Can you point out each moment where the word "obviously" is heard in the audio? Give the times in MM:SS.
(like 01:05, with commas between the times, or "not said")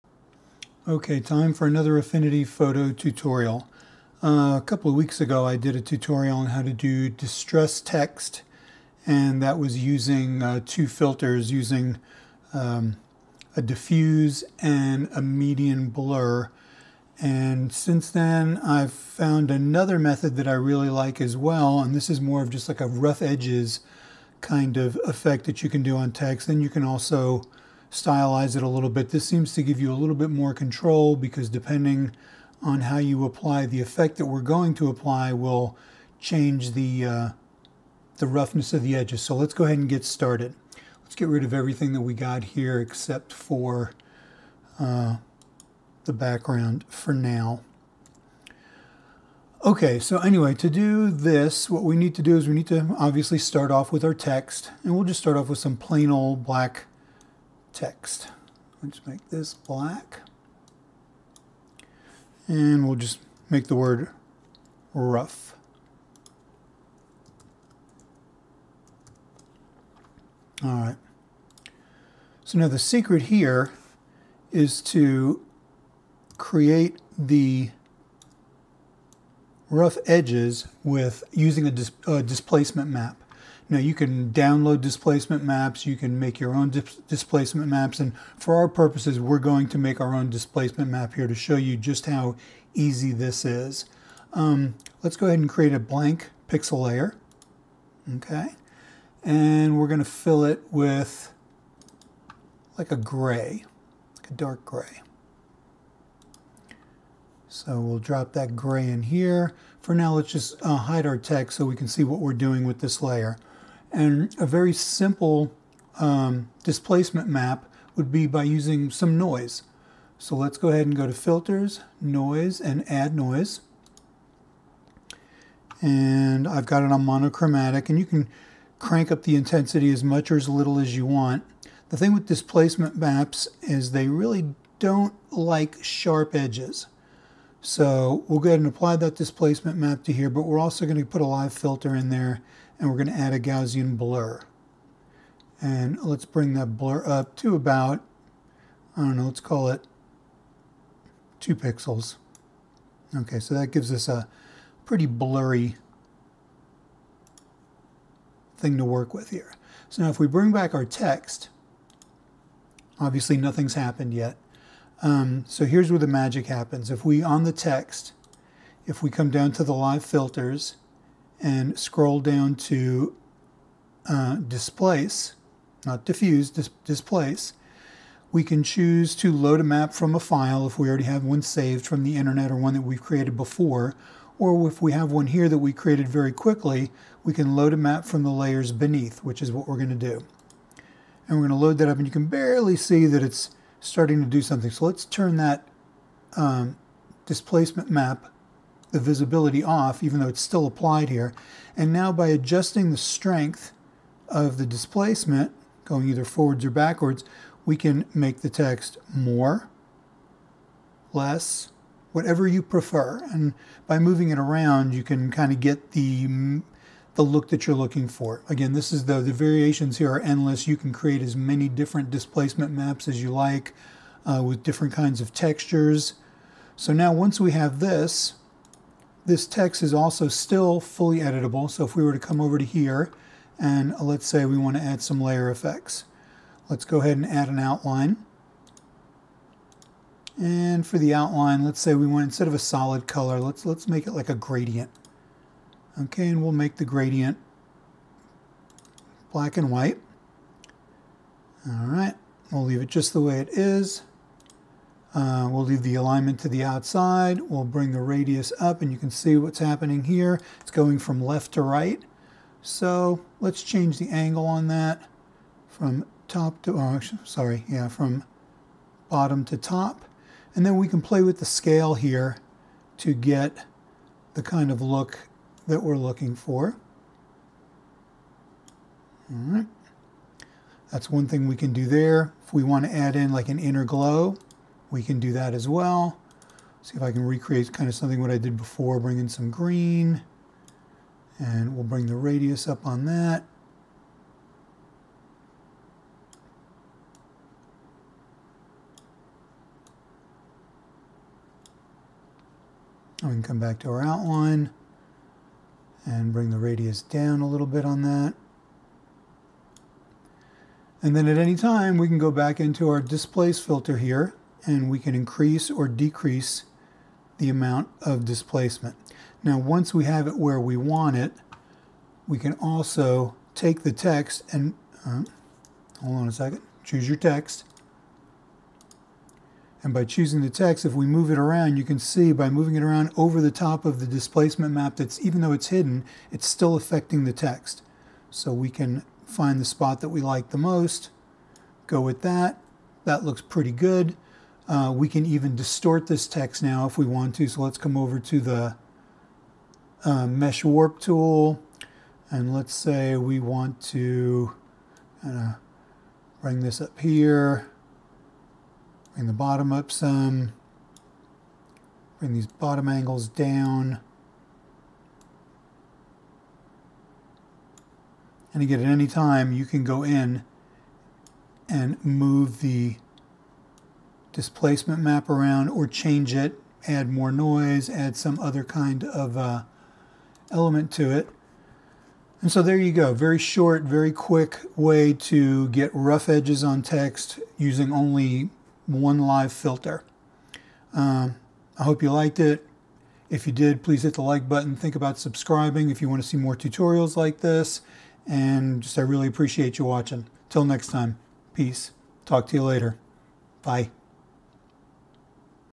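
00:52, 02:42.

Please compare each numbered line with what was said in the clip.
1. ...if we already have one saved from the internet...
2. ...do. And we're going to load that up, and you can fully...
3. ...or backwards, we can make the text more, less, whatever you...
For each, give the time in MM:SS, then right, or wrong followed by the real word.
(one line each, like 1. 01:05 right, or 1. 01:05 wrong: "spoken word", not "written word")
1. 03:00 right
2. 03:09 wrong: "barely", not "fully"
3. 03:26 right.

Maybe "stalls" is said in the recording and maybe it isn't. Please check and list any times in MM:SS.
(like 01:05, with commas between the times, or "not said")
not said.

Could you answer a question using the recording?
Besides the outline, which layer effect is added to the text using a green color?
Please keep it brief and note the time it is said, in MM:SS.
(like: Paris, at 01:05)
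inner glow, at 04:43.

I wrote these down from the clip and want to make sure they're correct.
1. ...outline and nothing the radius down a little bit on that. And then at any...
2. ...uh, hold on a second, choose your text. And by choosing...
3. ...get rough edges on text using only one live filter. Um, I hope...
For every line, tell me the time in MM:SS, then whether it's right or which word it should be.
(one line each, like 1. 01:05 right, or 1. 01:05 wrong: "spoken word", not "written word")
1. 05:04 wrong: "bring", not "nothing"
2. 05:25 right
3. 06:25 right.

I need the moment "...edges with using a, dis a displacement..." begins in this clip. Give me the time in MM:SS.
01:20.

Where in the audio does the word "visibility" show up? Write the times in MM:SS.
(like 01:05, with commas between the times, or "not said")
03:18.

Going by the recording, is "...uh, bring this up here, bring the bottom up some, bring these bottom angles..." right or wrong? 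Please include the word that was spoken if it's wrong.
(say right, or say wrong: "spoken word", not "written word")
right.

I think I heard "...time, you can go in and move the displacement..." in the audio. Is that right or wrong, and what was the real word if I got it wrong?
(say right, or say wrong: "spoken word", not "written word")
right.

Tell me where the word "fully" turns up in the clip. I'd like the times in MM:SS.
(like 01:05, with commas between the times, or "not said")
03:50.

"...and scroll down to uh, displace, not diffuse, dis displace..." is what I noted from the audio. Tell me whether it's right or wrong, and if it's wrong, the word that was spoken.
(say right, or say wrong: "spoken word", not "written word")
right.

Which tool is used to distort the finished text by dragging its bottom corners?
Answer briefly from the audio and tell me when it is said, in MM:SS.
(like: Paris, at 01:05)
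mesh warp tool, at 05:50.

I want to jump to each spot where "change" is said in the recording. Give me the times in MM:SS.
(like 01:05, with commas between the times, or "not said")
00:36, 04:23, 06:15.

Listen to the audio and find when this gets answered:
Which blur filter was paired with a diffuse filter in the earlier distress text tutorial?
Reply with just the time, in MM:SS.
00:15.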